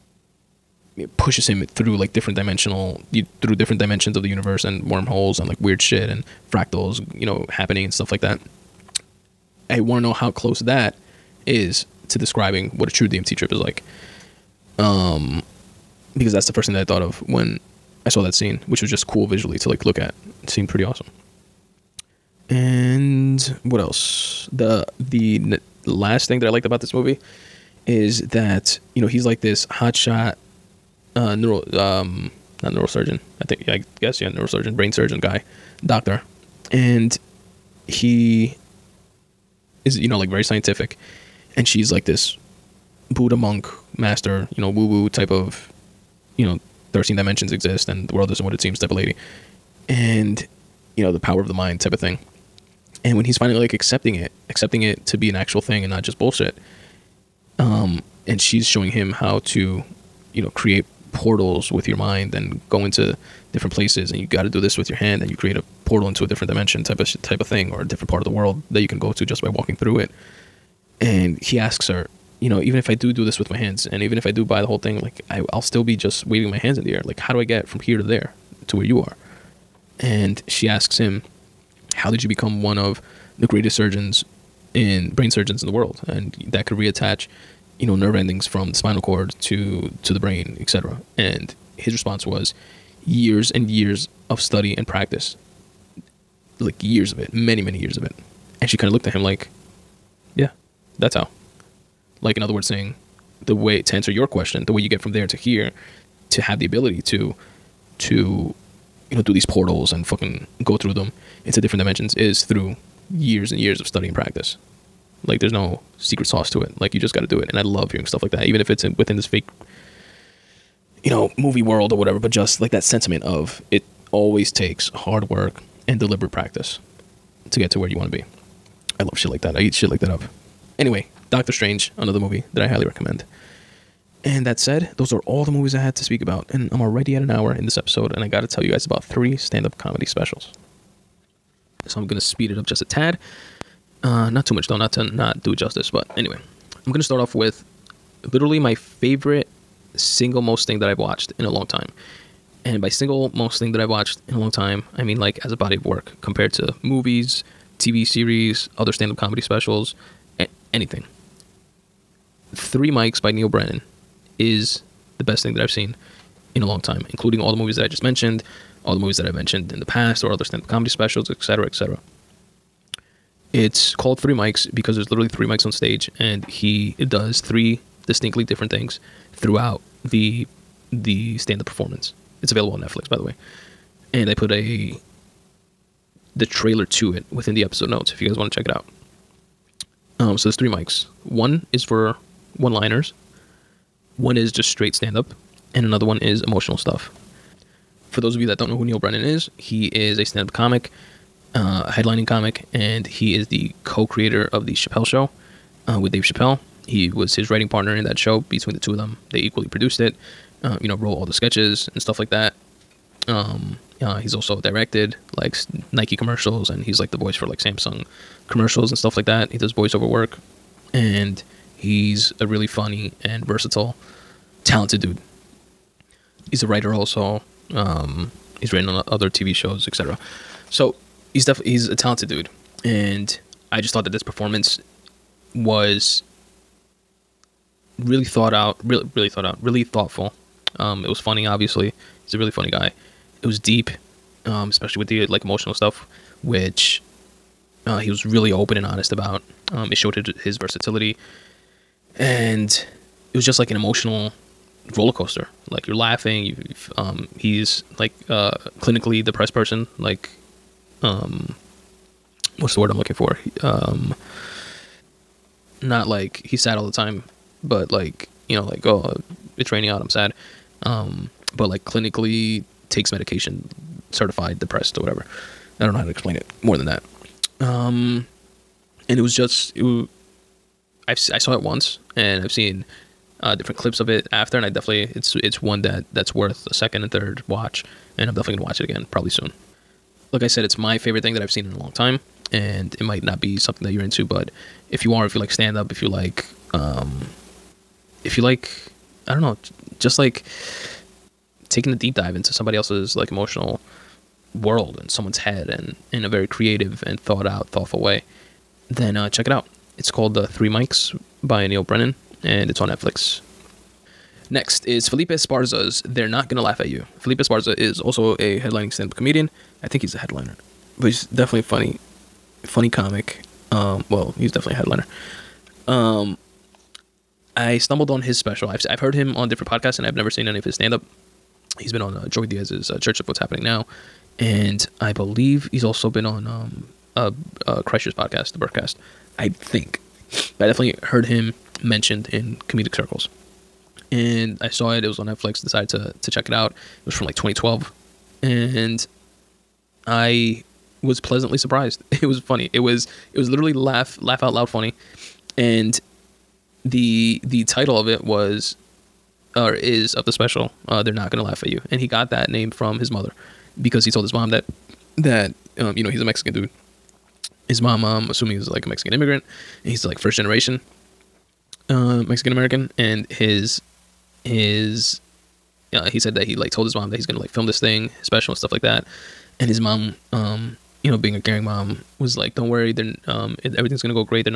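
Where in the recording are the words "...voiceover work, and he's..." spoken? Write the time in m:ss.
3:39.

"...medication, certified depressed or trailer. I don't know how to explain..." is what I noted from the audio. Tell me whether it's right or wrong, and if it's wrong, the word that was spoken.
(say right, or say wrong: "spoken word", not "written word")
wrong: "whatever", not "trailer".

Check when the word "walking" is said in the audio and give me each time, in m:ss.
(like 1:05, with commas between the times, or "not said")
1:09.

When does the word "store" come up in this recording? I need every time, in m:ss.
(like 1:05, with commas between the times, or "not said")
not said.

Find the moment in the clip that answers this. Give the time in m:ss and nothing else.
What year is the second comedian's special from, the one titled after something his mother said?
5:47.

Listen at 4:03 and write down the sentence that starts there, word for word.
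It was deep, um, especially with the like emotional stuff, which uh, he was really open and honest about.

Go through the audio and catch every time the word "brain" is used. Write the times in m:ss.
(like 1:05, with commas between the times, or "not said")
0:34, 1:25, 1:30.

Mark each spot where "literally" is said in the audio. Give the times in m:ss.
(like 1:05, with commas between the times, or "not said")
2:28, 2:55, 5:53.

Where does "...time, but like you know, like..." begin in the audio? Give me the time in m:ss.
4:26.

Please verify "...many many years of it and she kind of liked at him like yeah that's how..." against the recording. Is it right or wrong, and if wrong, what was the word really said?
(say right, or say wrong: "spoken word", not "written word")
wrong: "looked", not "liked".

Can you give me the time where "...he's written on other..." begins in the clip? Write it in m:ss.
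3:48.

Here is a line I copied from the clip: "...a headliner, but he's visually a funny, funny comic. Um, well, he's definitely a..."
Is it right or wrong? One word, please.
wrong.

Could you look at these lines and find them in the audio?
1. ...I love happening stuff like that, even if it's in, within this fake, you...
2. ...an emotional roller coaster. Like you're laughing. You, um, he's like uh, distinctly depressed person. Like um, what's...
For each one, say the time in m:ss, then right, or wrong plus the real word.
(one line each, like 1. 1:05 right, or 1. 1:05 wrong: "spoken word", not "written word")
1. 1:57 wrong: "hearing", not "happening"
2. 4:13 wrong: "clinically", not "distinctly".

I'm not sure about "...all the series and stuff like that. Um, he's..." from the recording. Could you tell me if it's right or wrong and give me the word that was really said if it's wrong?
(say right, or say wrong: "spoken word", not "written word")
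wrong: "sketches", not "series".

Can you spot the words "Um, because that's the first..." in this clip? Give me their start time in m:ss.
0:14.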